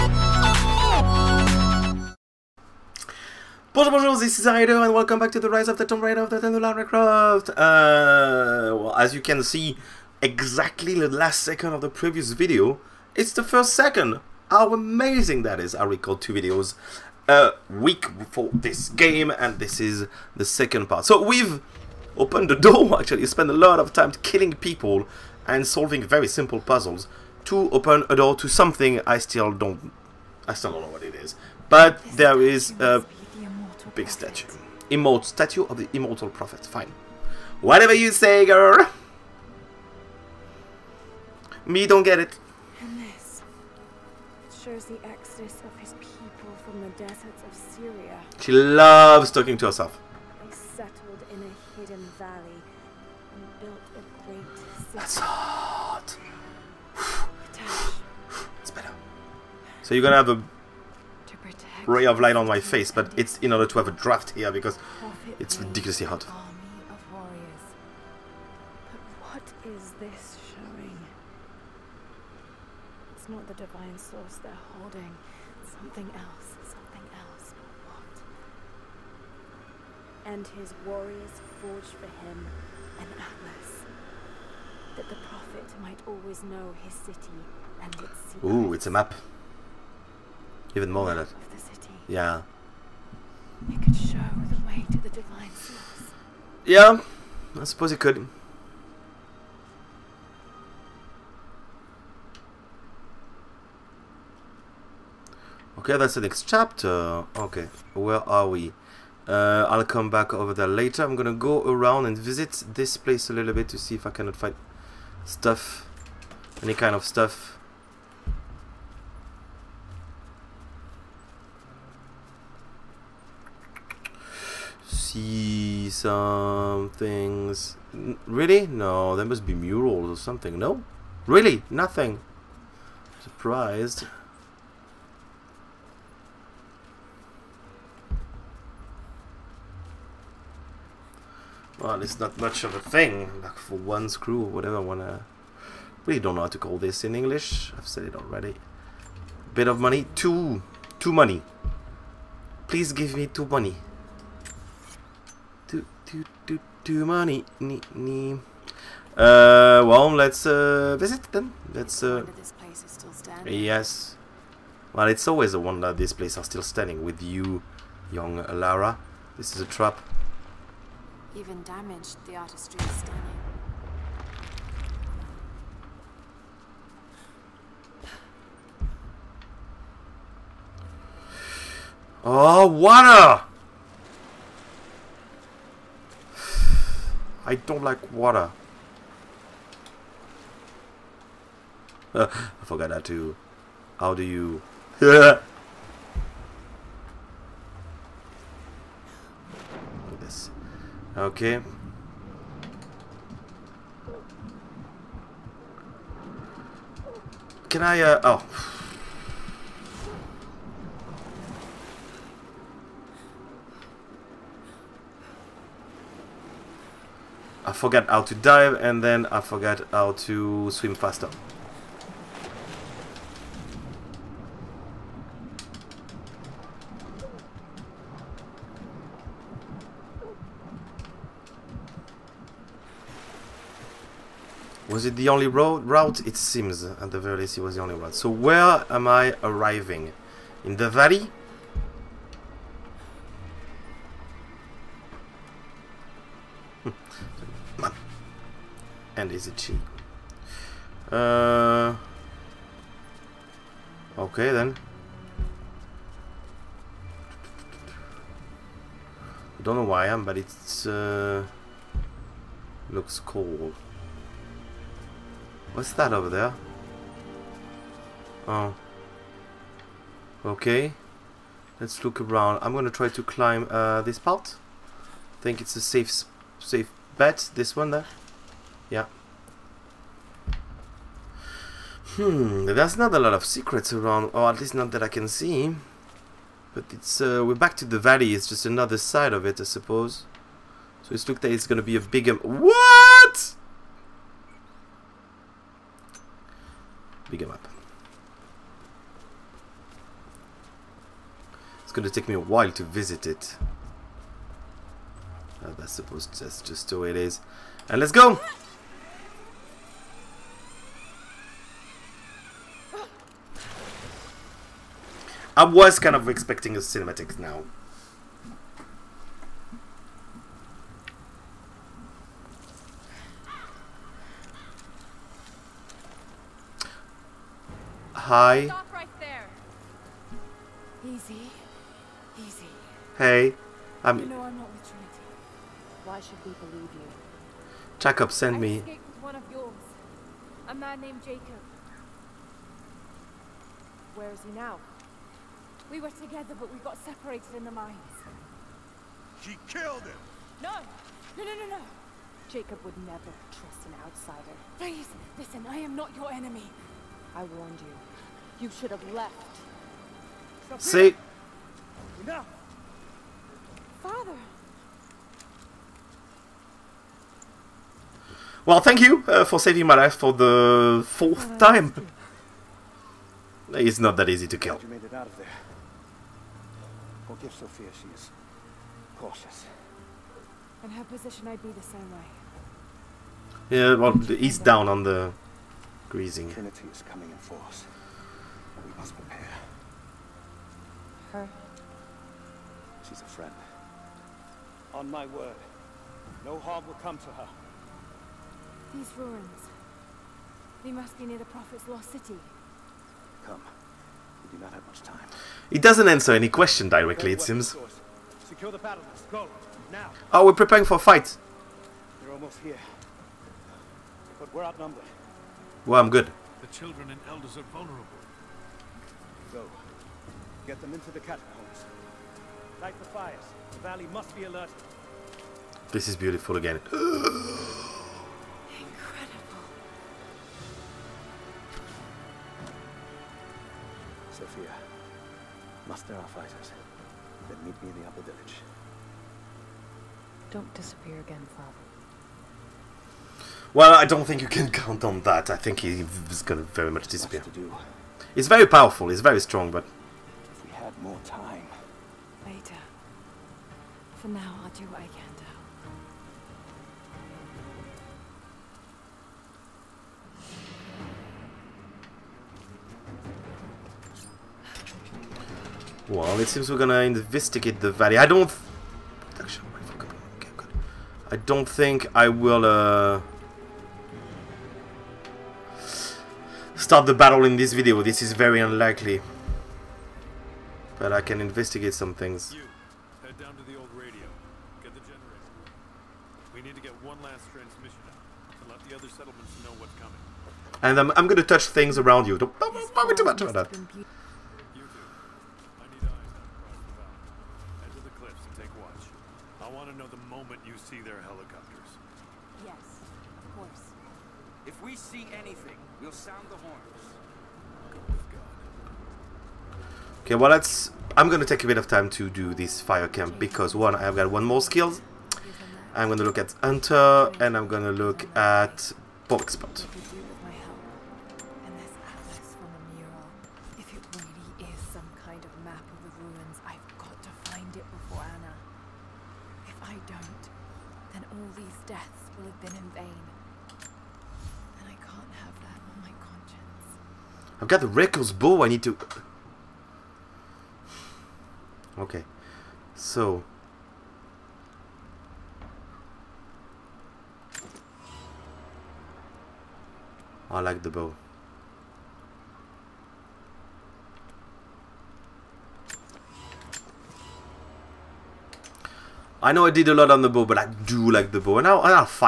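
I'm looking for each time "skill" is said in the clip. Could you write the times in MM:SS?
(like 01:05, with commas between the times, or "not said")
08:34.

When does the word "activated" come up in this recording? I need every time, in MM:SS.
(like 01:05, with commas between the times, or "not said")
not said.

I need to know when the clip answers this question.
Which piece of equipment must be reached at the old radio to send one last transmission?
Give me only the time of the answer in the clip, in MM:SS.
08:04.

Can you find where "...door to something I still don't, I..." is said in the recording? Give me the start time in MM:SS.
00:28.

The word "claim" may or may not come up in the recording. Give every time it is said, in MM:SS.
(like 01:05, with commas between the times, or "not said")
not said.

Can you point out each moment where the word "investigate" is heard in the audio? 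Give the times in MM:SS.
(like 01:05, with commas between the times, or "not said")
07:47, 08:01.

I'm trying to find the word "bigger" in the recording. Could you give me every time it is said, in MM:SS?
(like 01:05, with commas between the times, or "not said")
04:51, 04:57.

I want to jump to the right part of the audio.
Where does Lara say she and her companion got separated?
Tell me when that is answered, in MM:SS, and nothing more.
05:47.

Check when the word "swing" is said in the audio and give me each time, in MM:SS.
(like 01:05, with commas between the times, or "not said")
not said.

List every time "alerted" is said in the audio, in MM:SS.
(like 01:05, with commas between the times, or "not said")
07:04.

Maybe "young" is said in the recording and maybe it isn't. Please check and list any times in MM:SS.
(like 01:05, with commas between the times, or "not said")
02:48.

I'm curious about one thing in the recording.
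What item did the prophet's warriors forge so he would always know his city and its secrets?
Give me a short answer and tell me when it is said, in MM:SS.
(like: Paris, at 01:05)
An atlas, at 01:22.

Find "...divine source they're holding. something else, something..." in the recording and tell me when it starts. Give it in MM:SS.
01:13.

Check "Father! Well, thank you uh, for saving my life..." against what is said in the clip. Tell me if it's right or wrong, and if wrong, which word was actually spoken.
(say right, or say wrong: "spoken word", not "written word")
right.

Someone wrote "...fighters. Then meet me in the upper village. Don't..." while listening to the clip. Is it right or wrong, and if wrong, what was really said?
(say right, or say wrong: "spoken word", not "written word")
right.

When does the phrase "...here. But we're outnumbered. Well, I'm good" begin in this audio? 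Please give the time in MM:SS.
06:52.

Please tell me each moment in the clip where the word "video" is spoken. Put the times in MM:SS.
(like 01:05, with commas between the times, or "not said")
00:12, 00:16, 07:57.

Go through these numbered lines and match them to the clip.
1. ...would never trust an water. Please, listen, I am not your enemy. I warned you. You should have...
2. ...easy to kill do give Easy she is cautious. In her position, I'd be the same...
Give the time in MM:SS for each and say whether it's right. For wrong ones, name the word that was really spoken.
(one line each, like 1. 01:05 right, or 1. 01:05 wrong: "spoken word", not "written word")
1. 05:52 wrong: "outsider", not "water"
2. 06:14 wrong: "Sofia", not "Easy".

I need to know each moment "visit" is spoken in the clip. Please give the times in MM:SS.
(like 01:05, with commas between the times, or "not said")
01:52, 02:40, 05:02.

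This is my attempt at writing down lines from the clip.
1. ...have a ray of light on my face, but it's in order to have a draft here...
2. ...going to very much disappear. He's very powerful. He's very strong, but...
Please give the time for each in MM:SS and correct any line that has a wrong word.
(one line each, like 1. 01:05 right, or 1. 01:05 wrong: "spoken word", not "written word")
1. 01:00 right
2. 07:26 right.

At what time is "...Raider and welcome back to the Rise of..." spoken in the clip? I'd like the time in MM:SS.
00:04.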